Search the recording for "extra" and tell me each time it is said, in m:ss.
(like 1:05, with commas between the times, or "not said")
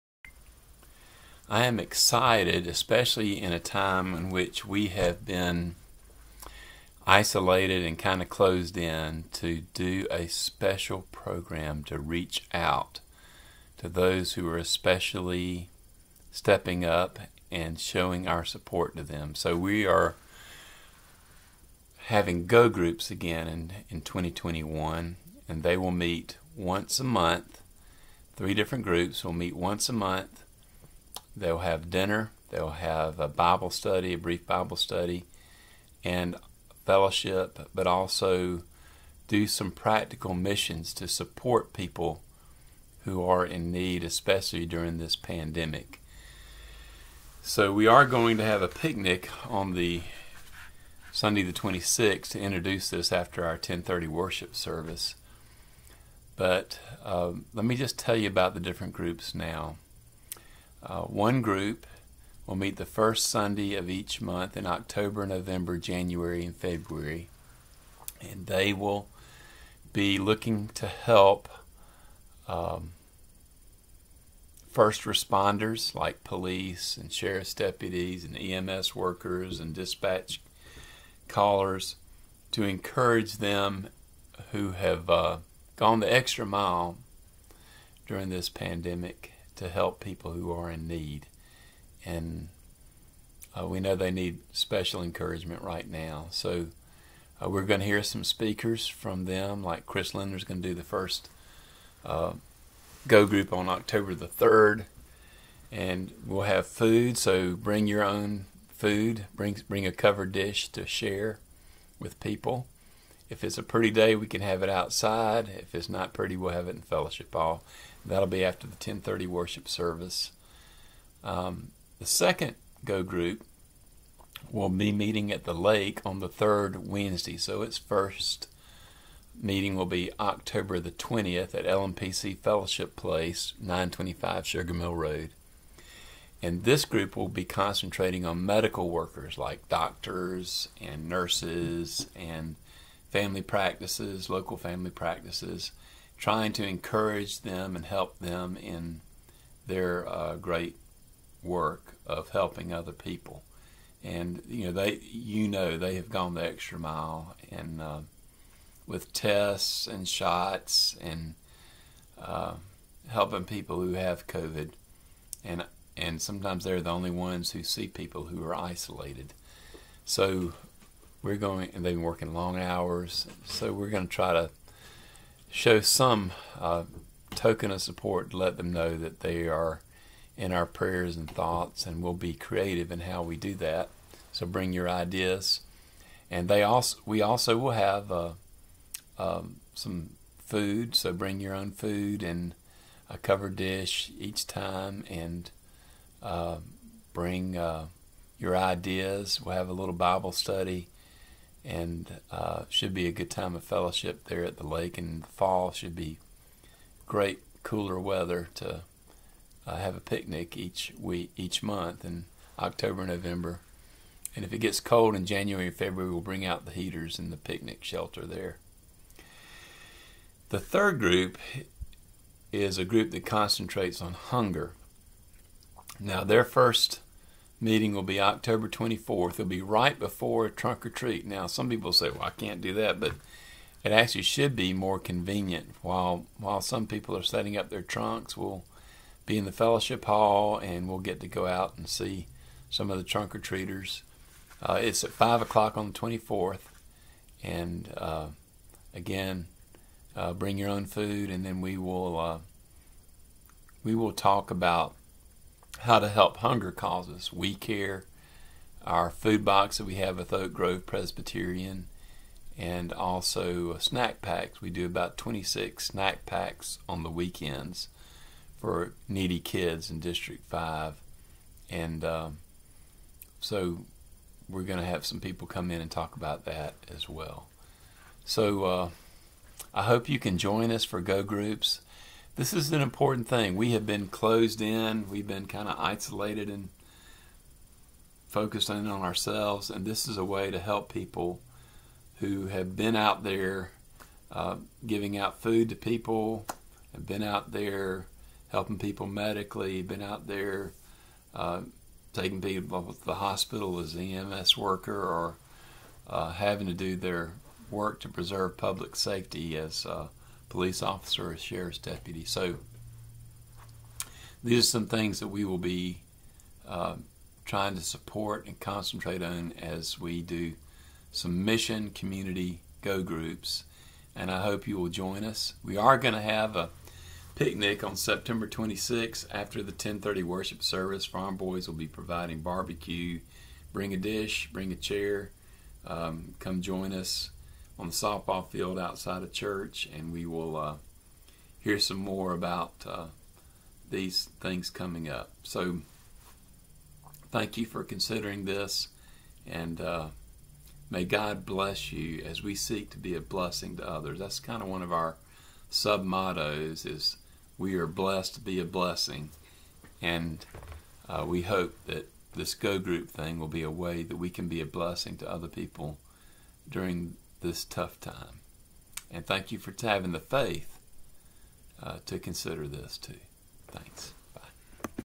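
1:26, 2:36.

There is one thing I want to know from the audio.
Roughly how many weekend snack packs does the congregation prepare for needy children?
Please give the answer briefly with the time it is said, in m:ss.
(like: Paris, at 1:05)
26, at 4:25.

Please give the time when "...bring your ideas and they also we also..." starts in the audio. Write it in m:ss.
3:04.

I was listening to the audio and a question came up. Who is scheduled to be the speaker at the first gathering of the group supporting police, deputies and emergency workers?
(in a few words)
Chris Linder.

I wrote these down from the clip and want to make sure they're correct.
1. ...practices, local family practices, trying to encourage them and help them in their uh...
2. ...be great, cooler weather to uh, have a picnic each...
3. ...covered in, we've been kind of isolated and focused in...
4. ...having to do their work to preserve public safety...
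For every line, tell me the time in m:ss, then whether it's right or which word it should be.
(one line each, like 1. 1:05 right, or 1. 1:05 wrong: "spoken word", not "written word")
1. 2:23 right
2. 3:25 right
3. 4:44 wrong: "closed", not "covered"
4. 5:06 right.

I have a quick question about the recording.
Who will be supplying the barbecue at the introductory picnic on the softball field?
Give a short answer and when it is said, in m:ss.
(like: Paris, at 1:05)
Farm boys, at 5:31.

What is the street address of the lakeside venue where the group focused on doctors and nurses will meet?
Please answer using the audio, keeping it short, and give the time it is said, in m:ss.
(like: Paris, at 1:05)
925 Sugar Mill Road, at 2:13.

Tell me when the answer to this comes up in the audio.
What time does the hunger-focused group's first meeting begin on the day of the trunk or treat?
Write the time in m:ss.
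4:05.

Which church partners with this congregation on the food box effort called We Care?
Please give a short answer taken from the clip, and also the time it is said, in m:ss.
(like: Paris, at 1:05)
Oak Grove Presbyterian, at 4:20.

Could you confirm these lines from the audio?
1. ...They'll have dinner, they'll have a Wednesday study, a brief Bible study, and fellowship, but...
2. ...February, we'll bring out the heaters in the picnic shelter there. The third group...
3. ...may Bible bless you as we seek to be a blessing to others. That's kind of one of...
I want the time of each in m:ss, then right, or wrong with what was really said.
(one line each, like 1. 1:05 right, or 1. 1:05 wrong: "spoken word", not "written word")
1. 0:31 wrong: "Bible", not "Wednesday"
2. 3:35 right
3. 5:50 wrong: "God", not "Bible".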